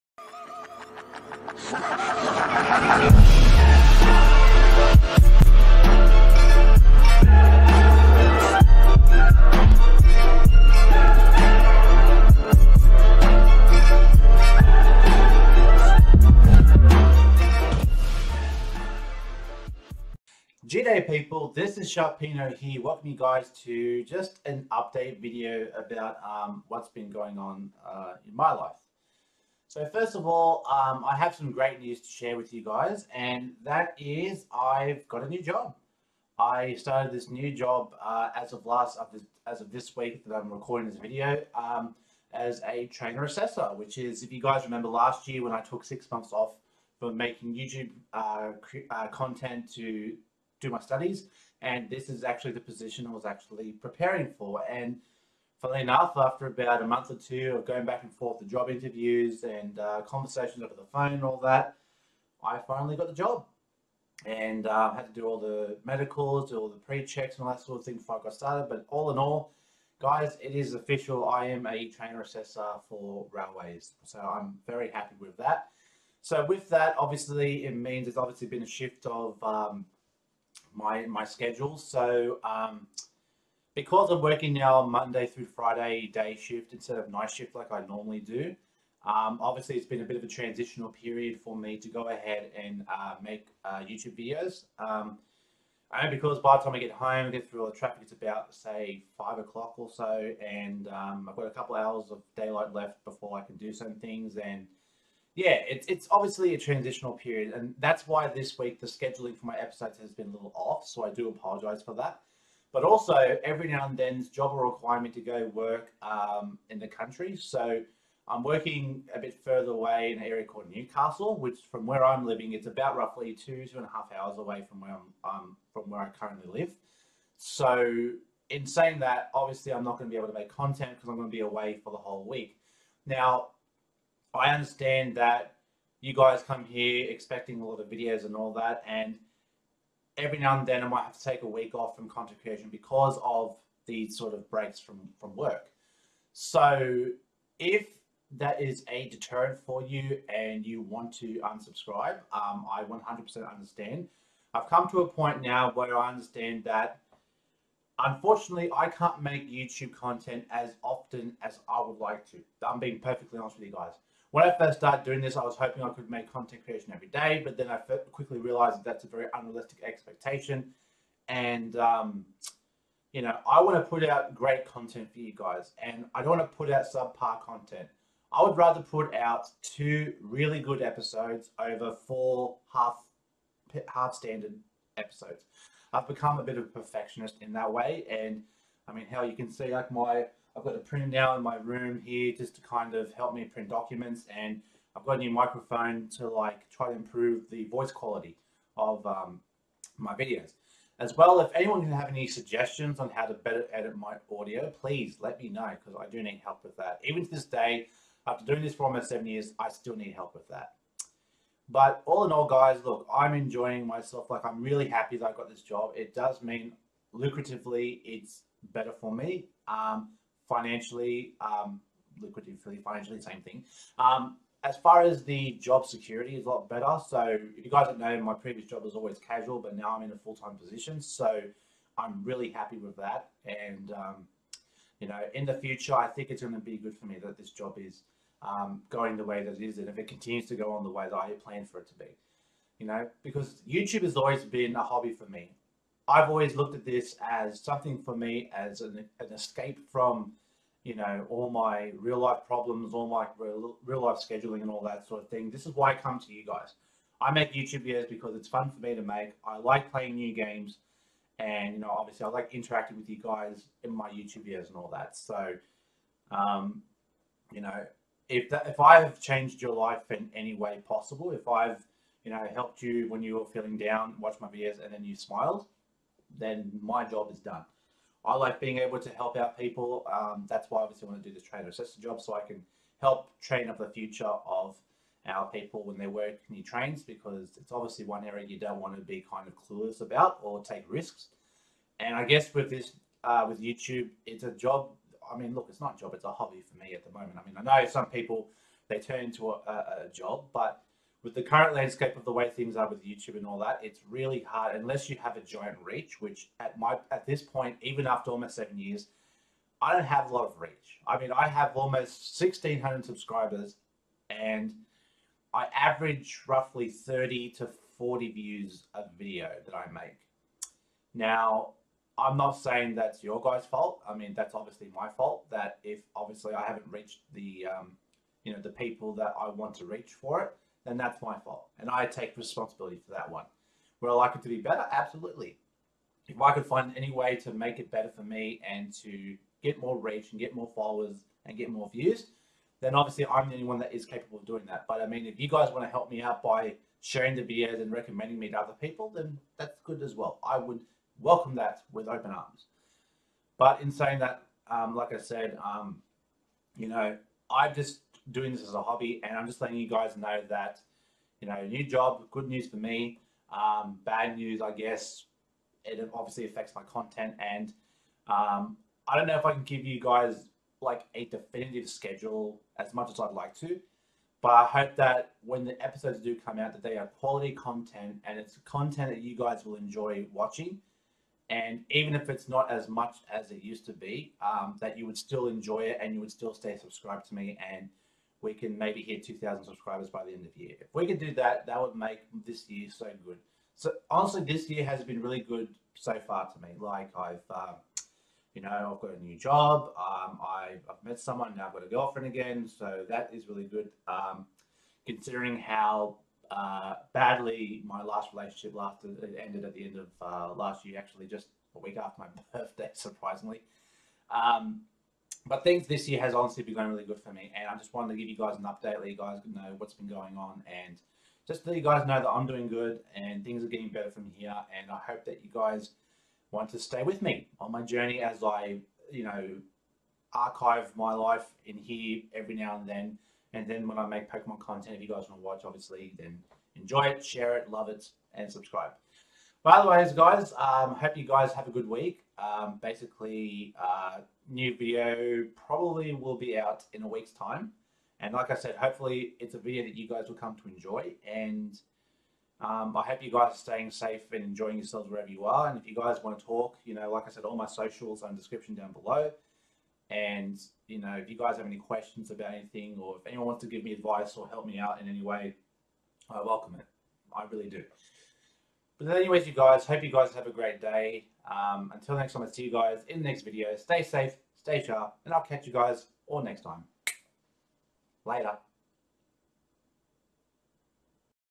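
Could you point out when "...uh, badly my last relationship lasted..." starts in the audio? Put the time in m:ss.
6:46.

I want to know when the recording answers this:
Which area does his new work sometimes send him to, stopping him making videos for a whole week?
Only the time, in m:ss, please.
2:00.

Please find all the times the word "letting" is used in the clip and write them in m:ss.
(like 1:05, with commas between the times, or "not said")
5:59.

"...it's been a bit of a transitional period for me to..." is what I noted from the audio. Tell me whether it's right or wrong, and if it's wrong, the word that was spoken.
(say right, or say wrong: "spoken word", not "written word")
right.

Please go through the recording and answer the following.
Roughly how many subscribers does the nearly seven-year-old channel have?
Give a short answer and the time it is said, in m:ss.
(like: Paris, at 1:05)
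1600, at 5:12.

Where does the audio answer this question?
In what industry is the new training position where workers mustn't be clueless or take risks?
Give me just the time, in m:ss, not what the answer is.
1:13.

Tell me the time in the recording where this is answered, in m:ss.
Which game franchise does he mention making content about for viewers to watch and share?
7:14.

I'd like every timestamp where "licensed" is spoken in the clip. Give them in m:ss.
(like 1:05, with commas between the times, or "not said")
not said.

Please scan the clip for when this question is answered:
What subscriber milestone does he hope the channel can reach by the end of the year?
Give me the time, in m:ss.
6:29.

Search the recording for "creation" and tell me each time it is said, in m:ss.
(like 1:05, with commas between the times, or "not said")
2:22, 2:46.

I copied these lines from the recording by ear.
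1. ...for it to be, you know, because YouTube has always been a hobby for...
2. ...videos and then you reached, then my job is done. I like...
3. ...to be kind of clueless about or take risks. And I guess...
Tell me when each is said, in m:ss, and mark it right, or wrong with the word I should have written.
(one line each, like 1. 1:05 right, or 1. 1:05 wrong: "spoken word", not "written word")
1. 4:01 right
2. 4:34 wrong: "smiled", not "reached"
3. 4:48 right.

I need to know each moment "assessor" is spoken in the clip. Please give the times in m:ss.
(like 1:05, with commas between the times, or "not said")
0:43, 1:12.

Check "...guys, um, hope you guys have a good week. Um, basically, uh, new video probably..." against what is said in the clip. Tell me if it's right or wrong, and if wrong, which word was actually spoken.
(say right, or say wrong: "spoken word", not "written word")
right.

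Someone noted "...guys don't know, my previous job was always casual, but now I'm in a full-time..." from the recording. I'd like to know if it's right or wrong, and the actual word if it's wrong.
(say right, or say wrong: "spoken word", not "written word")
right.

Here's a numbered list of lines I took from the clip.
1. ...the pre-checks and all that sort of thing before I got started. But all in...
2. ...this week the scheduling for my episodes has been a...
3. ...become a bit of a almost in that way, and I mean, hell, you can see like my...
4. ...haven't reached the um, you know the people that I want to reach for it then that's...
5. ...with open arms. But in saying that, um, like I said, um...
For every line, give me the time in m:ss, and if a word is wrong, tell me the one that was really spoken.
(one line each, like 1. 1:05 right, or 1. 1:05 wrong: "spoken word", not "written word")
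1. 1:06 right
2. 1:48 right
3. 3:06 wrong: "perfectionist", not "almost"
4. 5:26 right
5. 5:51 right.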